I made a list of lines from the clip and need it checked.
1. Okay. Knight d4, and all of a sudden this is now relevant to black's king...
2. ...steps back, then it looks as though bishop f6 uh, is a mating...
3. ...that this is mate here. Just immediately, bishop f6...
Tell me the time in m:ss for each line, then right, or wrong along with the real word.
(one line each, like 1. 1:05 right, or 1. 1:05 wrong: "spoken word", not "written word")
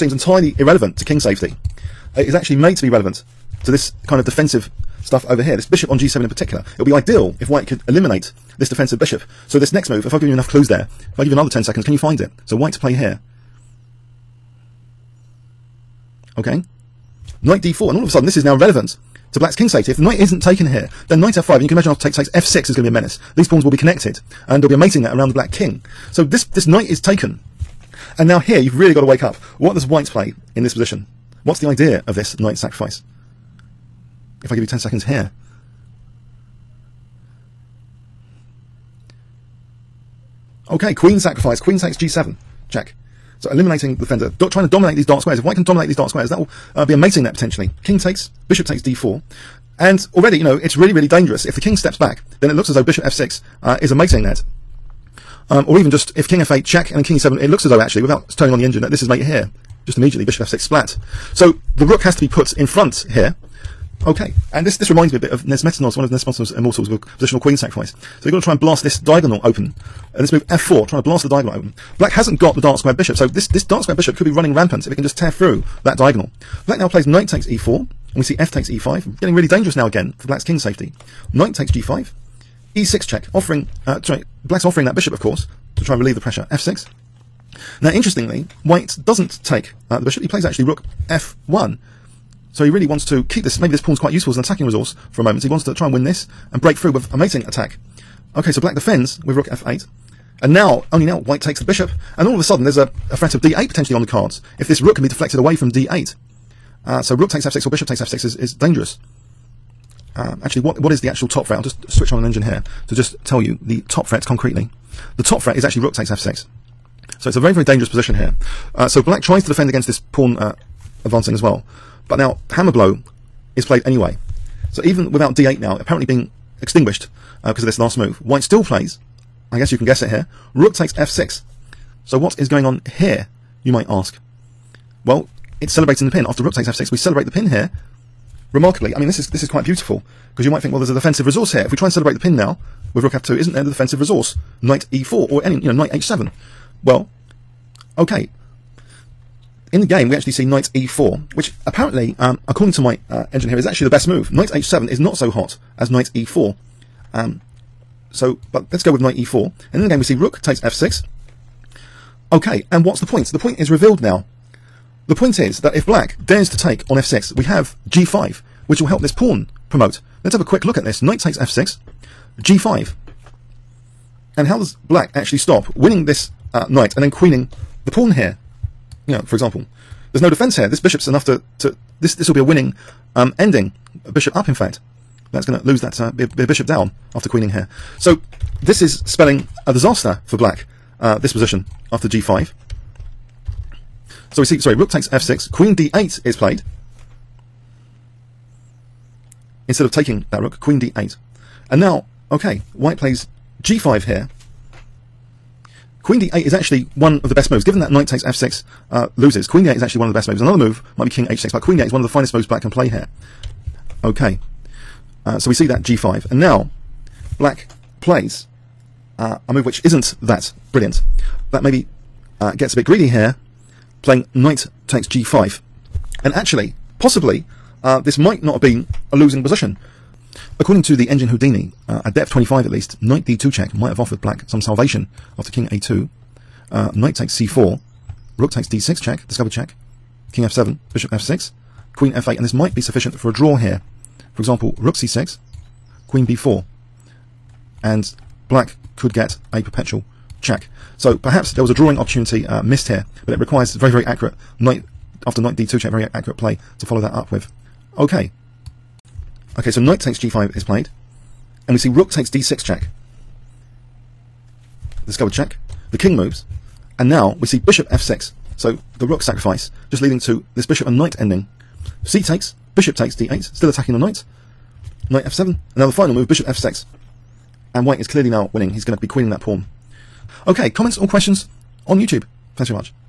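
1. 0:16 right
2. 0:51 right
3. 0:58 right.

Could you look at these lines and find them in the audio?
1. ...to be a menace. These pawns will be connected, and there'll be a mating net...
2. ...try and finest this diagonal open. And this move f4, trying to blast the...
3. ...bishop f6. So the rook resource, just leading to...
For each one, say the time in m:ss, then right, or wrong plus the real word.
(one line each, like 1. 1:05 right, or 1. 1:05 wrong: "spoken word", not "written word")
1. 0:22 right
2. 1:08 wrong: "blast", not "finest"
3. 4:27 wrong: "sacrifice", not "resource".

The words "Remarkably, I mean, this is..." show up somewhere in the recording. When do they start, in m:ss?
2:18.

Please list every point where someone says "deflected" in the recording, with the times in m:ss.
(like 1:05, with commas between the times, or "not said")
1:45.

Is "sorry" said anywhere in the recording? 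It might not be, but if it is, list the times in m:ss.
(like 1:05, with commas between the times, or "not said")
1:24, 3:14.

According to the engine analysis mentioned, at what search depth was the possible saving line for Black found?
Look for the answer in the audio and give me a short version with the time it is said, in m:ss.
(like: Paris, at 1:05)
25, at 3:52.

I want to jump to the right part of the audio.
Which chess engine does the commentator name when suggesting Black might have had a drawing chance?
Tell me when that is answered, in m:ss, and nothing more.
3:51.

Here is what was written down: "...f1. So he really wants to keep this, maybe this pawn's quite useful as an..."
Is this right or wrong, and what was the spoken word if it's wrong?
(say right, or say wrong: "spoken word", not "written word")
right.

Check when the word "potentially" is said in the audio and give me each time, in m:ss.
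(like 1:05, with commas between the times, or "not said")
0:47, 1:43.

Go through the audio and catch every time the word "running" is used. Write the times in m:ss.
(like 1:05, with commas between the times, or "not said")
1:14.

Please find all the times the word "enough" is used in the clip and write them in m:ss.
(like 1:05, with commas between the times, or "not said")
0:10, 3:01.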